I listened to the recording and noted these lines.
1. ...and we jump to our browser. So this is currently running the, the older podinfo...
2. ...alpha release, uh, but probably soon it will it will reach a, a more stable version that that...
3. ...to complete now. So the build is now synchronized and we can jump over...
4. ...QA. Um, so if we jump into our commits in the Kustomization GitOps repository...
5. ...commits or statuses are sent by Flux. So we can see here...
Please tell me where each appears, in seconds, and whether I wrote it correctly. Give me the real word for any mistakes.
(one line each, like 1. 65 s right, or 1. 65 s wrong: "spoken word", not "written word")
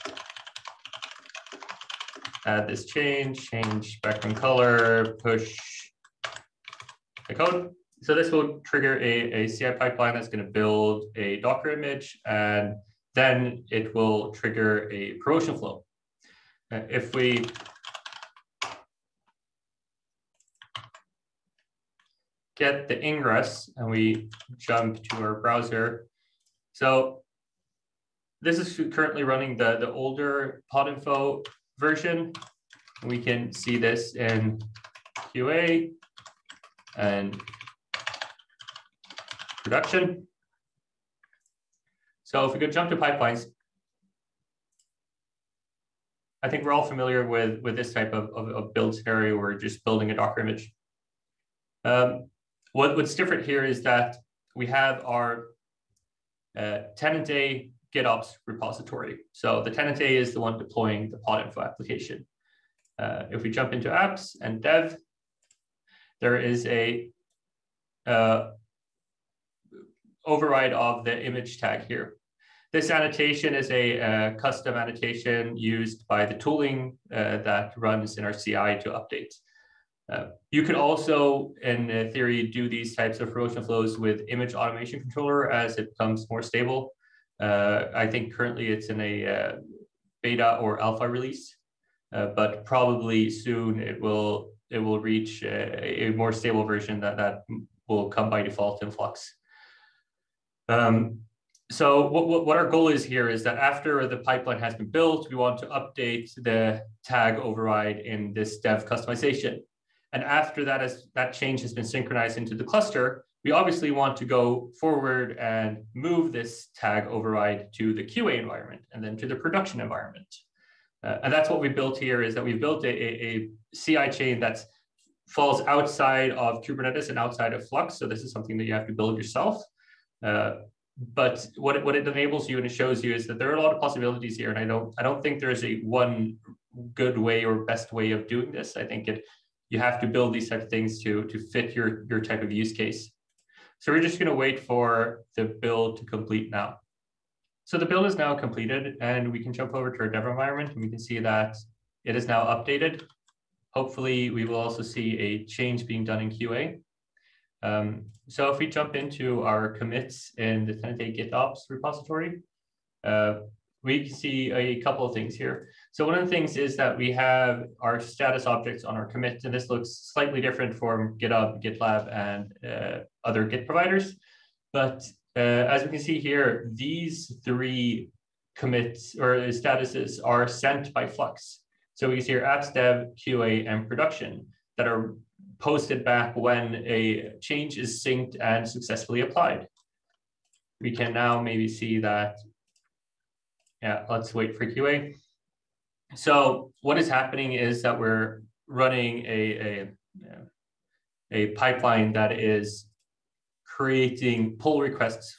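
1. 23 s right
2. 90 s right
3. 145 s wrong: "completed", not "synchronized"
4. 156 s wrong: "Tenate", not "Kustomization"
5. 178 s right.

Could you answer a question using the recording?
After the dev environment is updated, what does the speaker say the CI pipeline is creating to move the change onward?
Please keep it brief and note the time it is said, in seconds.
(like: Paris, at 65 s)
pull requests, at 204 s.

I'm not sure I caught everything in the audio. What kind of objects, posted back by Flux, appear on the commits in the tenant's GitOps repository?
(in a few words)
status objects.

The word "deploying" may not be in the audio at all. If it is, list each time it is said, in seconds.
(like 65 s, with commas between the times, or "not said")
60 s.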